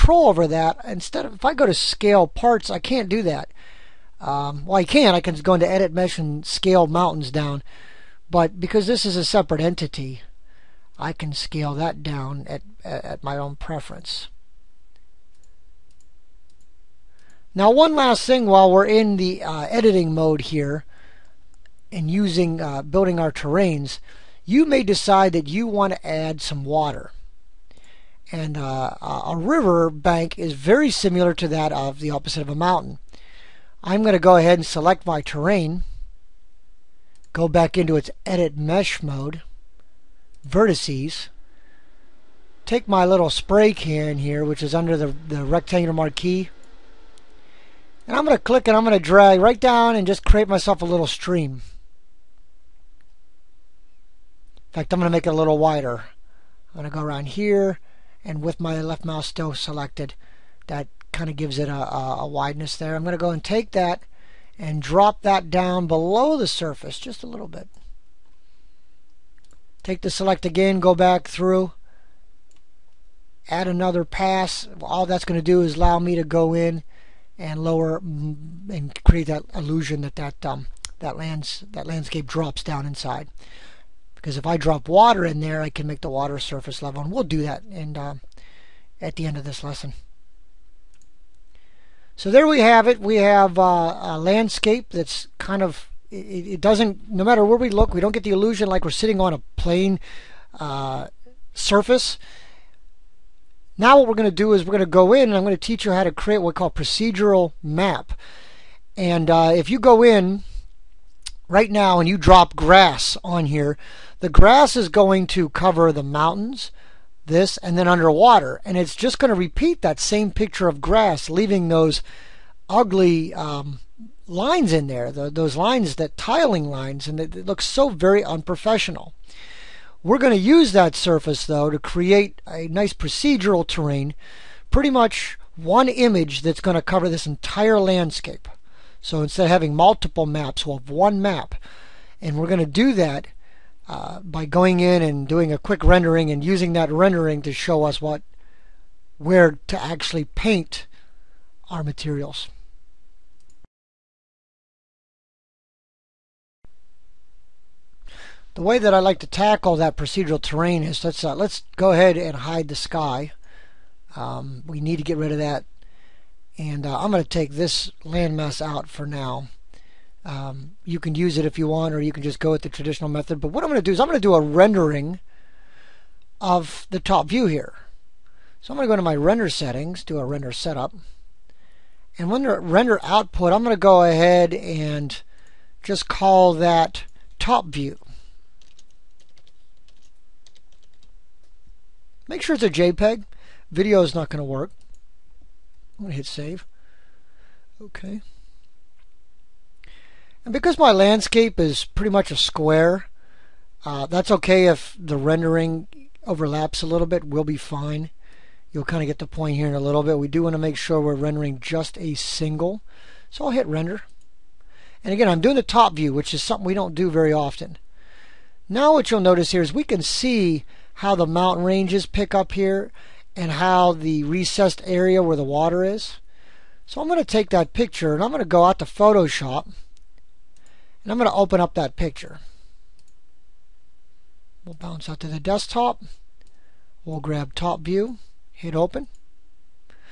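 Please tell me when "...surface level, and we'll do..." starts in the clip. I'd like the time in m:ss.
1:26.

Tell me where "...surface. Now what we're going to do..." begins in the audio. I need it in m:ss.
1:41.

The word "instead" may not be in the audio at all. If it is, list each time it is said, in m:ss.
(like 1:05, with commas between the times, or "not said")
0:00, 2:19.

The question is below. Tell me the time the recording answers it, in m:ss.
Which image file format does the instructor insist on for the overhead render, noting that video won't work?
3:12.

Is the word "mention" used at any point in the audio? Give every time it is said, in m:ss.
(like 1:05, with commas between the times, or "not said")
not said.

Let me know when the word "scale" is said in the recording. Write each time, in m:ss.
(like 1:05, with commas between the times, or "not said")
0:01, 0:06, 0:11.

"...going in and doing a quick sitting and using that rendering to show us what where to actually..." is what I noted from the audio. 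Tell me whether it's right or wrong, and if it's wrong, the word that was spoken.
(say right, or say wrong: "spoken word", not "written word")
wrong: "rendering", not "sitting".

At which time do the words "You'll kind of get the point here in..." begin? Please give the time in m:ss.
3:28.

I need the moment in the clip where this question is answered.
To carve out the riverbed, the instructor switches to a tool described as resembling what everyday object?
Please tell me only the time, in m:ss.
0:43.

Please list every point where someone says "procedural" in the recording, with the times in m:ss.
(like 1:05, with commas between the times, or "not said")
1:46, 2:12, 2:39.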